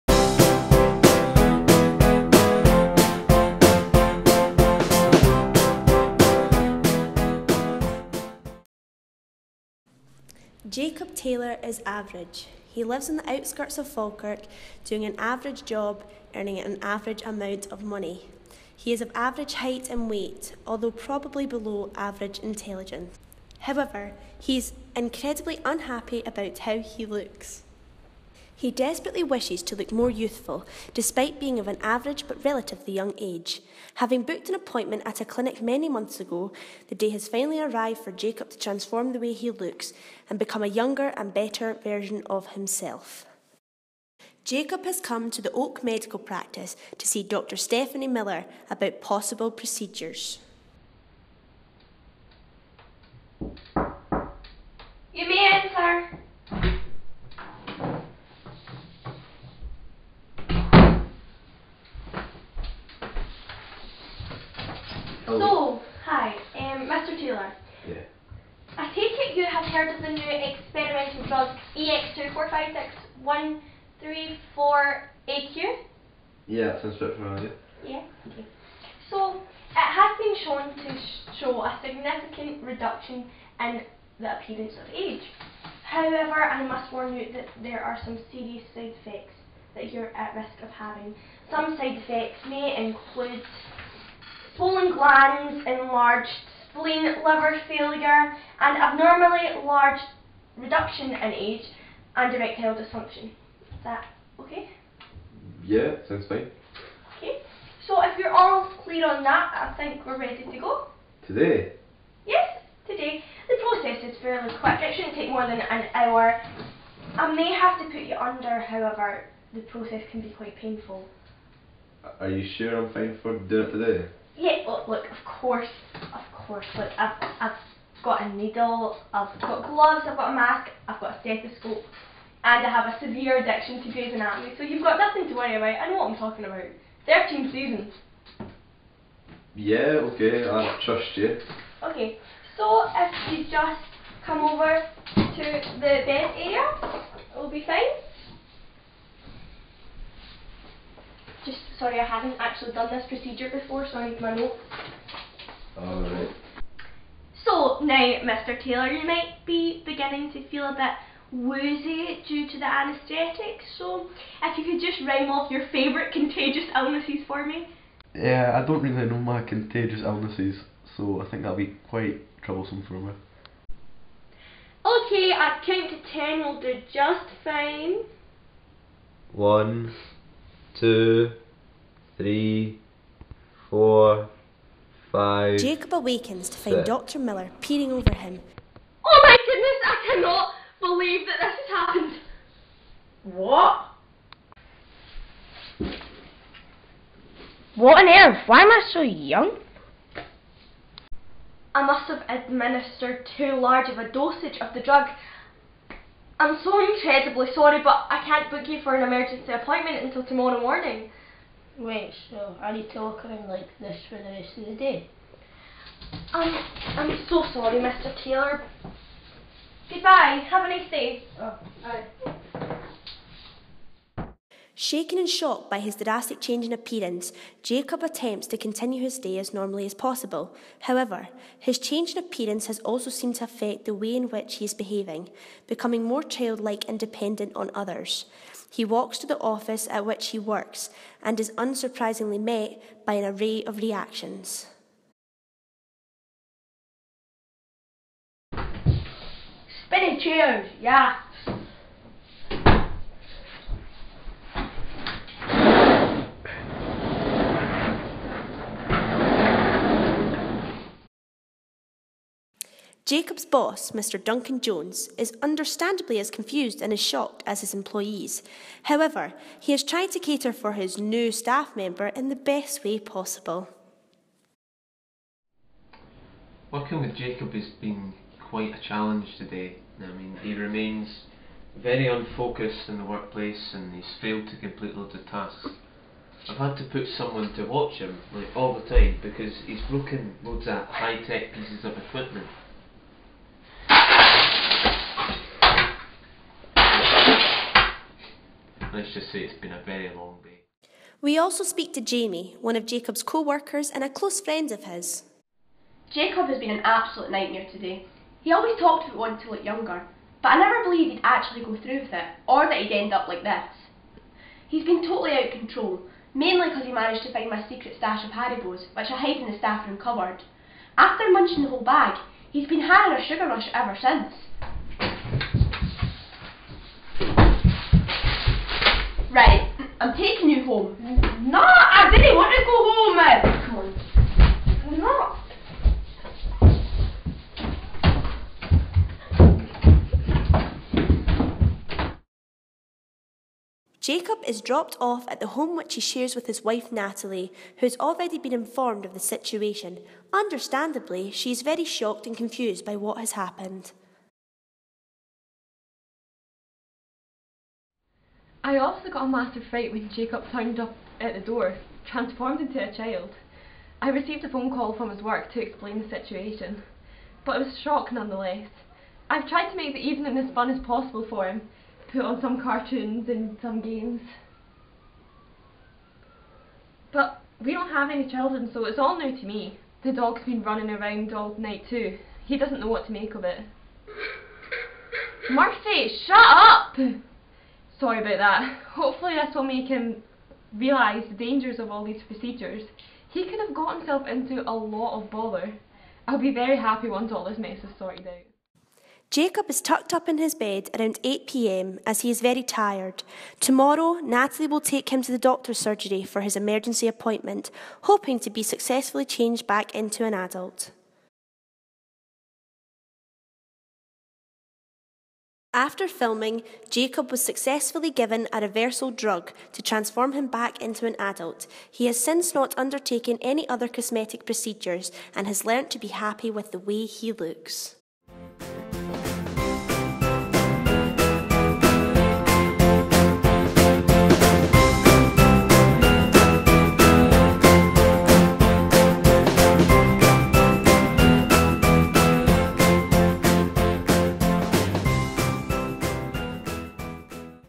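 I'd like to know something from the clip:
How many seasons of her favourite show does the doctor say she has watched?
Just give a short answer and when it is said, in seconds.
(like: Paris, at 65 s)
13, at 137 s.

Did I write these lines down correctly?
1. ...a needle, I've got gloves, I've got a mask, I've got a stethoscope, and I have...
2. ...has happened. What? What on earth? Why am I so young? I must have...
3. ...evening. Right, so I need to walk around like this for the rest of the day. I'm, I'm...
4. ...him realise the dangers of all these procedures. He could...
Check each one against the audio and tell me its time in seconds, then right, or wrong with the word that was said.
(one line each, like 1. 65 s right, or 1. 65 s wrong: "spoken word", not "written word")
1. 128 s right
2. 191 s right
3. 210 s wrong: "morning", not "evening"
4. 389 s right.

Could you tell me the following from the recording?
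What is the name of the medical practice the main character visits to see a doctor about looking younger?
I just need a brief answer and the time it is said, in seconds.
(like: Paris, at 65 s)
Oak Medical Practice, at 45 s.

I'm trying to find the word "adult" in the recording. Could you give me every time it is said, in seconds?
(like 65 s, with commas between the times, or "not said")
410 s, 421 s.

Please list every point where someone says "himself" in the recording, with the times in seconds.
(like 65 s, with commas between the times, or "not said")
42 s, 393 s.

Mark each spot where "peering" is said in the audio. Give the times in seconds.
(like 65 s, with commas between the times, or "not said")
187 s.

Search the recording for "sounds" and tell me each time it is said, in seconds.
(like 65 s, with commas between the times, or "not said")
76 s, 106 s.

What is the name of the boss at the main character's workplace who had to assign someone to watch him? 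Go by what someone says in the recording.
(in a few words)
Duncan Jones.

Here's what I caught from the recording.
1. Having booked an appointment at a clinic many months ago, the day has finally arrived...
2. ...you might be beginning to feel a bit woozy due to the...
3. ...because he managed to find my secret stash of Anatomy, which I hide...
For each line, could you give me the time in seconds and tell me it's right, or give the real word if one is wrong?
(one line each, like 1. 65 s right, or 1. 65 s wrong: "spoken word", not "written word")
1. 33 s right
2. 158 s right
3. 316 s wrong: "Haribos", not "Anatomy".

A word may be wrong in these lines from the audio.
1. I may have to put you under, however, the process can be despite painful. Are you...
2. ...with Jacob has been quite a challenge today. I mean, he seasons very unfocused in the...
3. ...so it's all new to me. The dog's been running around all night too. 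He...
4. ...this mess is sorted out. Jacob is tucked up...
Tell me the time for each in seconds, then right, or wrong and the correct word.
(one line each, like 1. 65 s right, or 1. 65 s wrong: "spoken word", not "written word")
1. 117 s wrong: "quite", not "despite"
2. 277 s wrong: "remains", not "seasons"
3. 378 s right
4. 397 s right.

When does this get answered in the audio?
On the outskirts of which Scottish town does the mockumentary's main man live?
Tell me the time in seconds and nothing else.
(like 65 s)
13 s.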